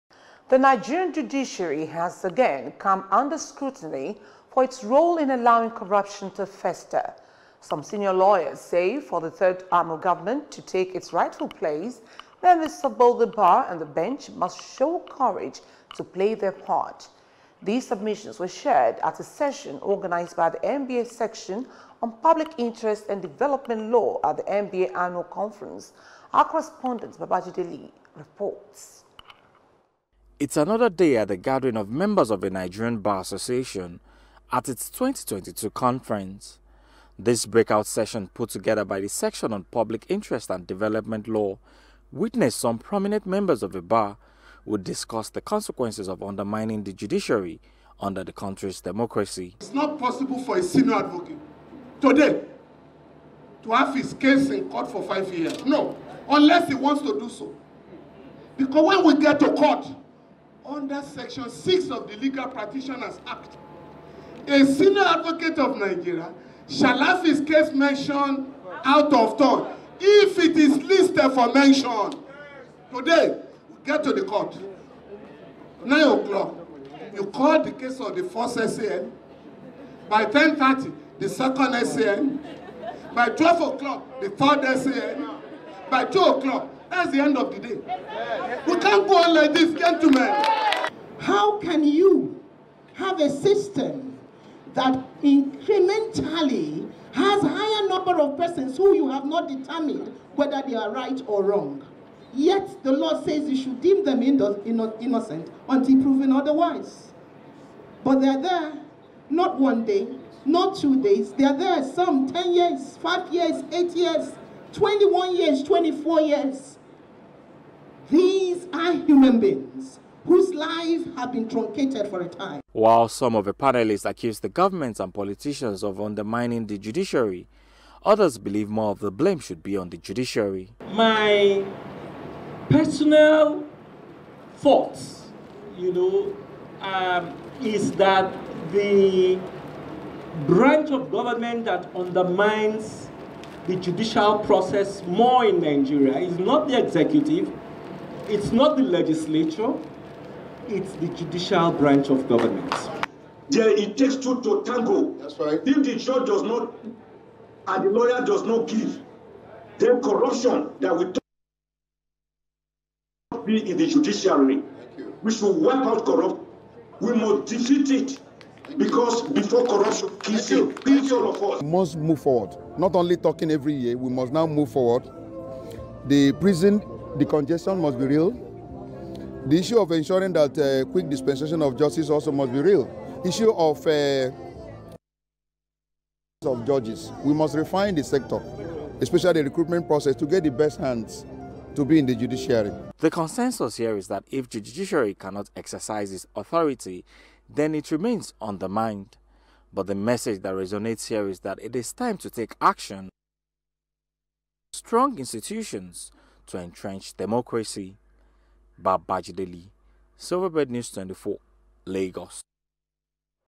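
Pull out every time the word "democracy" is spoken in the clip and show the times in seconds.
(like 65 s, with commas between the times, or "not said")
48 s, 207 s.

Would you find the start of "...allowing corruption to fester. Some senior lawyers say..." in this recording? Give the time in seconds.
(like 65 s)
5 s.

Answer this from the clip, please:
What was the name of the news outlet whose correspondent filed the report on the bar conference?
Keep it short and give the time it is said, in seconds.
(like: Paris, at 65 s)
Silverbird News 24, at 210 s.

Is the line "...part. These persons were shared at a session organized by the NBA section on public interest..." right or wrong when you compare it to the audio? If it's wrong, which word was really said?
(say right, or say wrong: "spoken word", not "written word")
wrong: "submissions", not "persons".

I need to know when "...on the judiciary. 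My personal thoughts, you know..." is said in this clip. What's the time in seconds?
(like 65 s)
129 s.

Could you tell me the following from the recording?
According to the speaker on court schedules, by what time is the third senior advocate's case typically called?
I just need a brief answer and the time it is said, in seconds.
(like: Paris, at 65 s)
12 o'clock, at 83 s.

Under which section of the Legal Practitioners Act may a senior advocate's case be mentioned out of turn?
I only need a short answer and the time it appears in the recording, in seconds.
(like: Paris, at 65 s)
Section 6, at 61 s.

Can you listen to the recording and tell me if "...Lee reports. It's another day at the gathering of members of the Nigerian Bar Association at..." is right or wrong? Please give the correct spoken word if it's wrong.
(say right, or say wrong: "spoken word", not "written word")
right.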